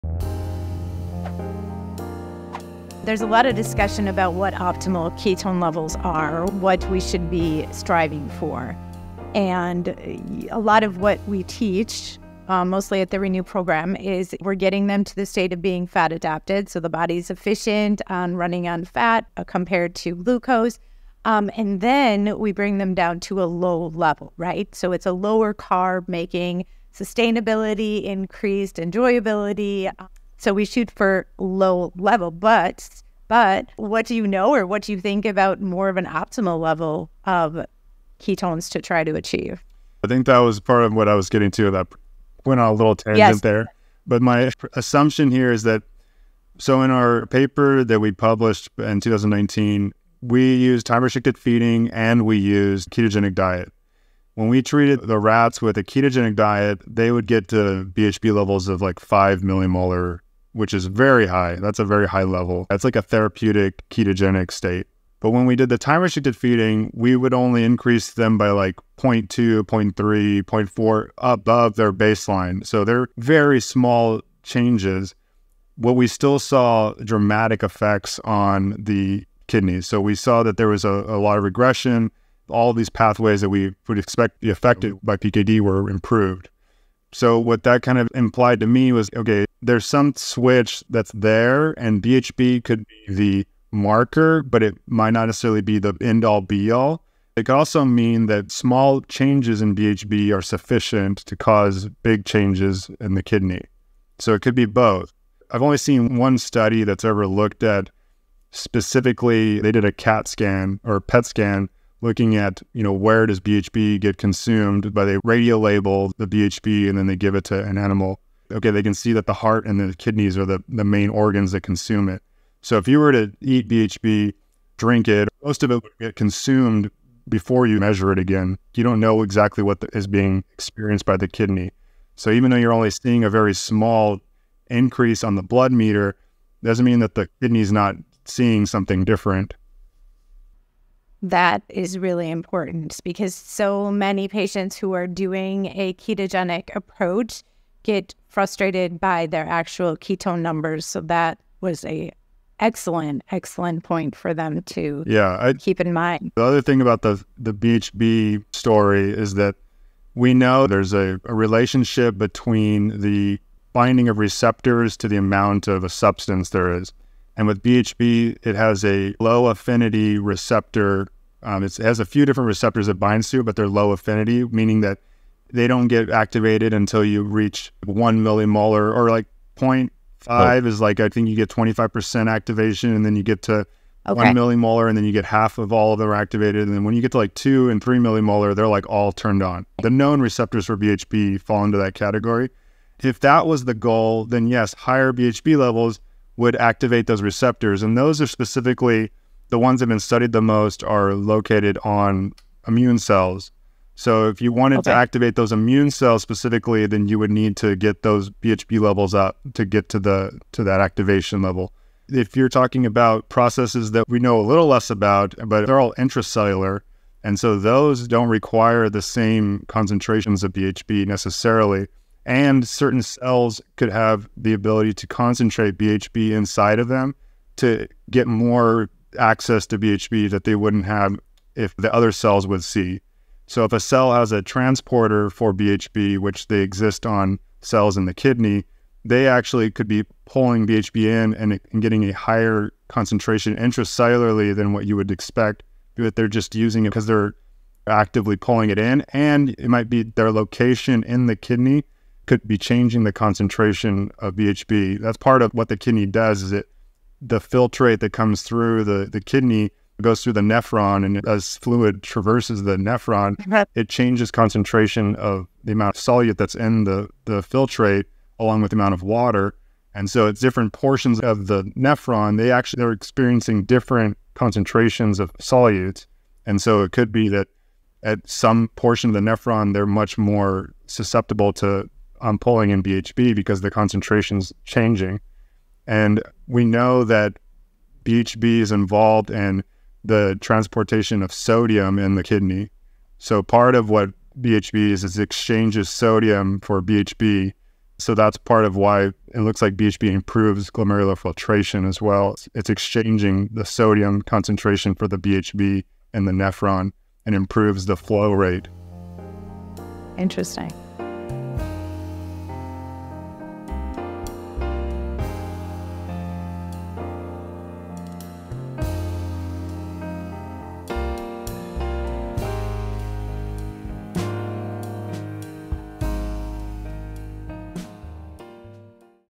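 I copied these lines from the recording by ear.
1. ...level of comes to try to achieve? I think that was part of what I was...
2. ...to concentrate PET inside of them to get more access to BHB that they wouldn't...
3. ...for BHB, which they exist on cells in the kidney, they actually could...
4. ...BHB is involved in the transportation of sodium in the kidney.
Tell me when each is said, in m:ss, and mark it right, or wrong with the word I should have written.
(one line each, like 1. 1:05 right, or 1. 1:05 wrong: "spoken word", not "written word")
1. 0:36 wrong: "ketones", not "comes"
2. 3:44 wrong: "BHB", not "PET"
3. 3:55 right
4. 4:48 right.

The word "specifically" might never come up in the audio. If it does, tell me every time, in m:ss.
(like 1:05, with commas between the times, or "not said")
1:48, 3:18, 3:26.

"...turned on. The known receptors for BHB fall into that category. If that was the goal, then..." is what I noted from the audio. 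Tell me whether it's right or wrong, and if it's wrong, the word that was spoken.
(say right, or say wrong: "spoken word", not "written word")
right.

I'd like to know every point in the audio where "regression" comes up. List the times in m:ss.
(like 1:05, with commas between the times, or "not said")
1:21.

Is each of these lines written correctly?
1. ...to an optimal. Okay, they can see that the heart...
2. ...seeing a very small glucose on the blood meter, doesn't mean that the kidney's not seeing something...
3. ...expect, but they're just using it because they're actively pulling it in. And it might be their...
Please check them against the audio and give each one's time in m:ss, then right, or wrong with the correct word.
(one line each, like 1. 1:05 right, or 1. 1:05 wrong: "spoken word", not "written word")
1. 1:57 wrong: "animal", not "optimal"
2. 2:12 wrong: "increase", not "glucose"
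3. 4:05 right.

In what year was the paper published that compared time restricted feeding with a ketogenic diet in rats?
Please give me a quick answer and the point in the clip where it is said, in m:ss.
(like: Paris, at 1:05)
2019, at 0:48.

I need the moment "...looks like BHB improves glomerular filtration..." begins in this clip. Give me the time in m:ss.
4:59.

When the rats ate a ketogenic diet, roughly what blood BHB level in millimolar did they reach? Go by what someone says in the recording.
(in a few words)
5 millimolar.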